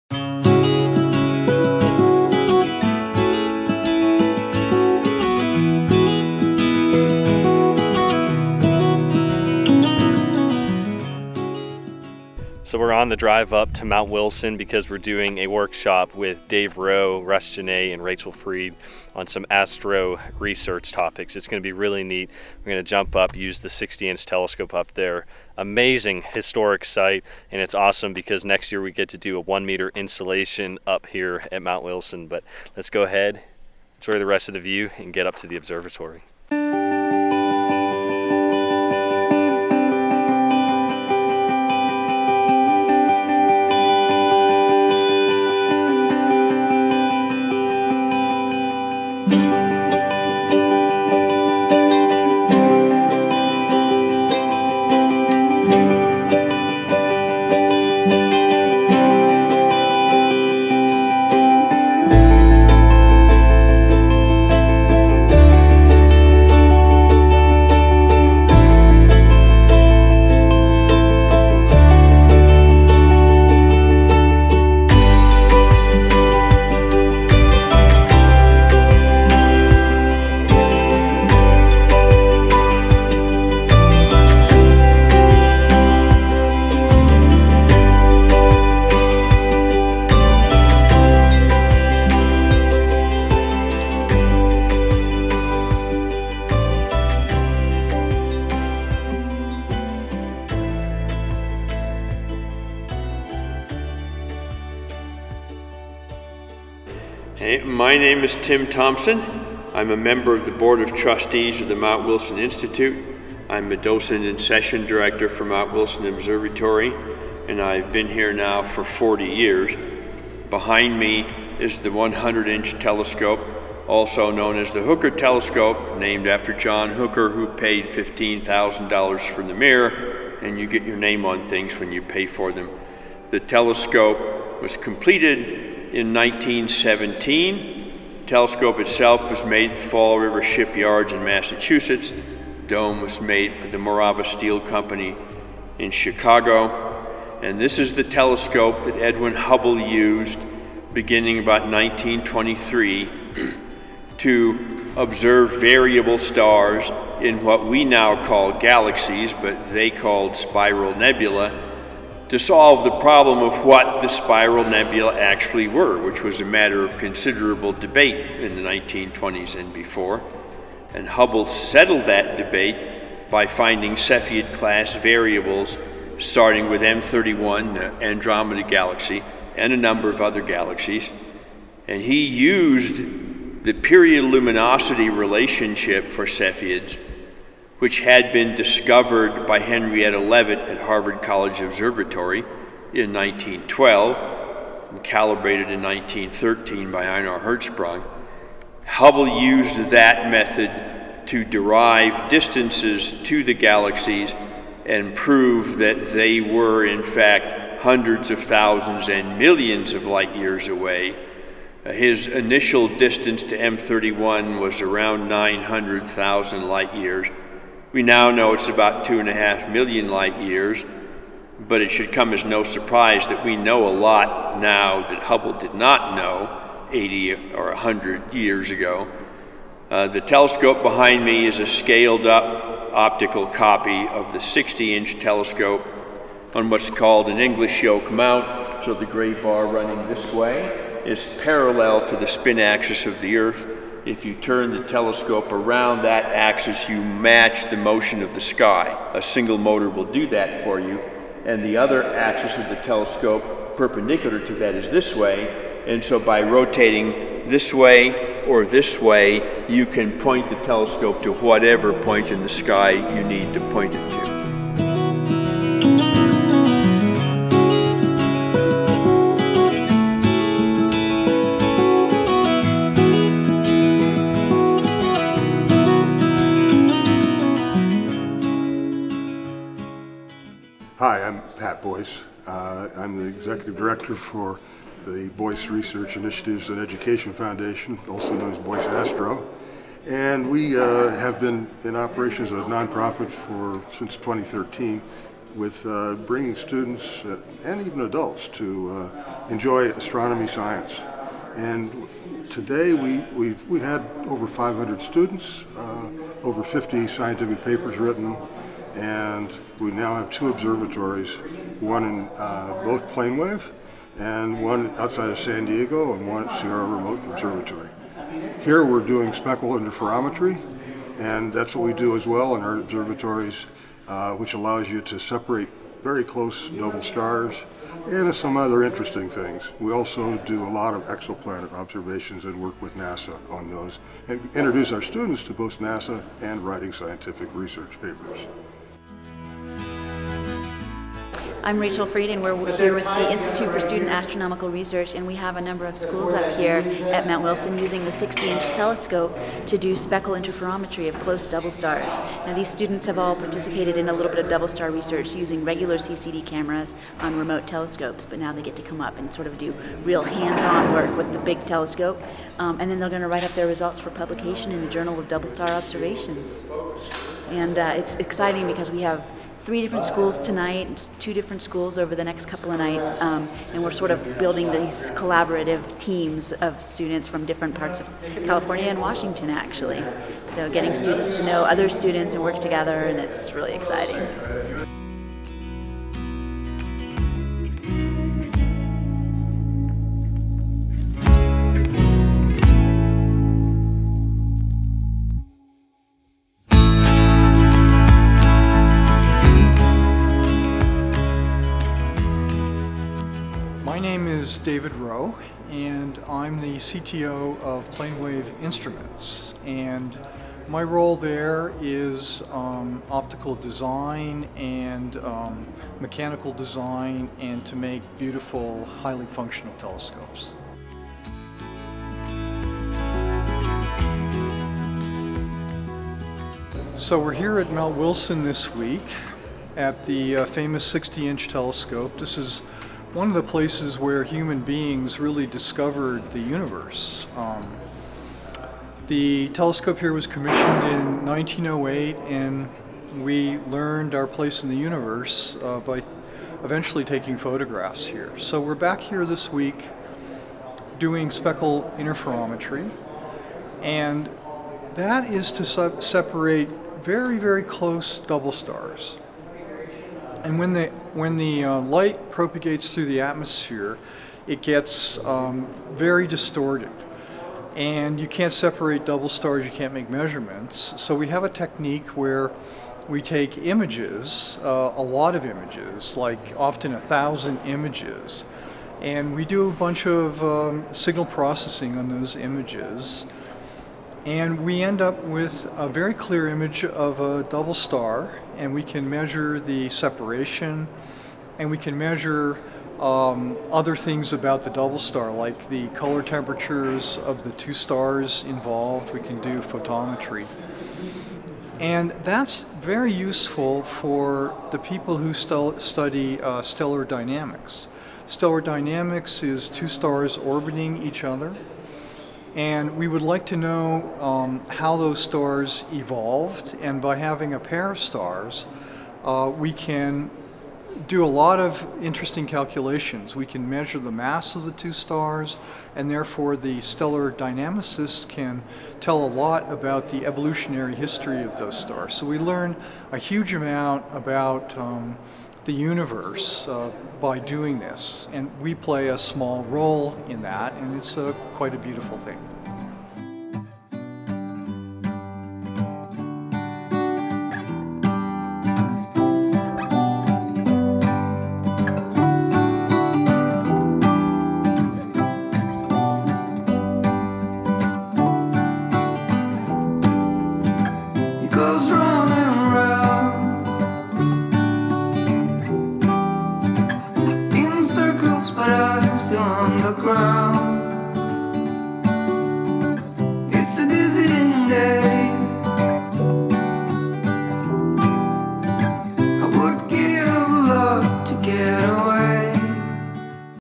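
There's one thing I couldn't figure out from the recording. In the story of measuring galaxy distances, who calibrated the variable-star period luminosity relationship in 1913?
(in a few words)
Ejnar Hertzsprung.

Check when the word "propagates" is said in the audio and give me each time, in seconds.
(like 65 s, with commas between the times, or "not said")
462 s.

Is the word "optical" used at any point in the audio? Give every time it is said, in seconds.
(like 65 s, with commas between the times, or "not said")
232 s, 413 s.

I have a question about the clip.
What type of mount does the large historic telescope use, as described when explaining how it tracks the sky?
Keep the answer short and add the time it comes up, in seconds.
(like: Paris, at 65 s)
English yoke mount, at 237 s.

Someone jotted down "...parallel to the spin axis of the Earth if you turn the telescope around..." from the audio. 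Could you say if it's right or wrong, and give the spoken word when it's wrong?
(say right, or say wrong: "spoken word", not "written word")
right.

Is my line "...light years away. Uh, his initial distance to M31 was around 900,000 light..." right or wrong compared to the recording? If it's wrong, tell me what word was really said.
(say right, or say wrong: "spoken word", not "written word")
right.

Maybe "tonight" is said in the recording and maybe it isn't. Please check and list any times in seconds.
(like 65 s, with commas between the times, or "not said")
370 s.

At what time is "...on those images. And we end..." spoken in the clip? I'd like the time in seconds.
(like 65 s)
481 s.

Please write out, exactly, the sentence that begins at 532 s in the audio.
So we learn a huge amount about um, the universe uh, by doing this.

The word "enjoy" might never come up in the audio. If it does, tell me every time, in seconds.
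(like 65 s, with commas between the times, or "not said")
33 s, 299 s.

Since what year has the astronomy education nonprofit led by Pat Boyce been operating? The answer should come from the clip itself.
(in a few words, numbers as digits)
2013.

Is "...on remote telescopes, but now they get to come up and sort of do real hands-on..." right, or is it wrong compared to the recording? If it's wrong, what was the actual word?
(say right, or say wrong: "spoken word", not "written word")
right.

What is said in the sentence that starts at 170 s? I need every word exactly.
And Hubble settled that debate by finding Cepheid class variables starting with M31, the Andromeda Galaxy, and a number of other galaxies.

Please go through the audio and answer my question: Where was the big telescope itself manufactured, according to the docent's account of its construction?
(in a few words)
Fall River Shipyards.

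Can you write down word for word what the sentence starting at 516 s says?
And by having a pair of stars, uh, we can do a lot of interesting calculations.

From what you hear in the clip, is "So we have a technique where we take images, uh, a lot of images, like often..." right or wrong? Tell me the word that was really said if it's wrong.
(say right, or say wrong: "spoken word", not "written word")
right.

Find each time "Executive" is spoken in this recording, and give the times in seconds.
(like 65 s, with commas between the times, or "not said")
283 s.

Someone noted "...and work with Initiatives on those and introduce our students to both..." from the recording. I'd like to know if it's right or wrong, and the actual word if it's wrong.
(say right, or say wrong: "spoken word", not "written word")
wrong: "NASA", not "Initiatives".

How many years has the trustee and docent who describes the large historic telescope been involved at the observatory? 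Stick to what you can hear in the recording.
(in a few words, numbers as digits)
40 years.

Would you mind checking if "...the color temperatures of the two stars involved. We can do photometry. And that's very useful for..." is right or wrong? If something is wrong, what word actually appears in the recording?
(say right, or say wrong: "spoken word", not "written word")
right.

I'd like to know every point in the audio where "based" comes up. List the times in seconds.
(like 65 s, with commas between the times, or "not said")
not said.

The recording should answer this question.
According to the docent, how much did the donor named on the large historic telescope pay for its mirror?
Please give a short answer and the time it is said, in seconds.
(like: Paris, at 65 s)
$15,000, at 127 s.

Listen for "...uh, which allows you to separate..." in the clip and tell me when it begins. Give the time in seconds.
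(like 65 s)
324 s.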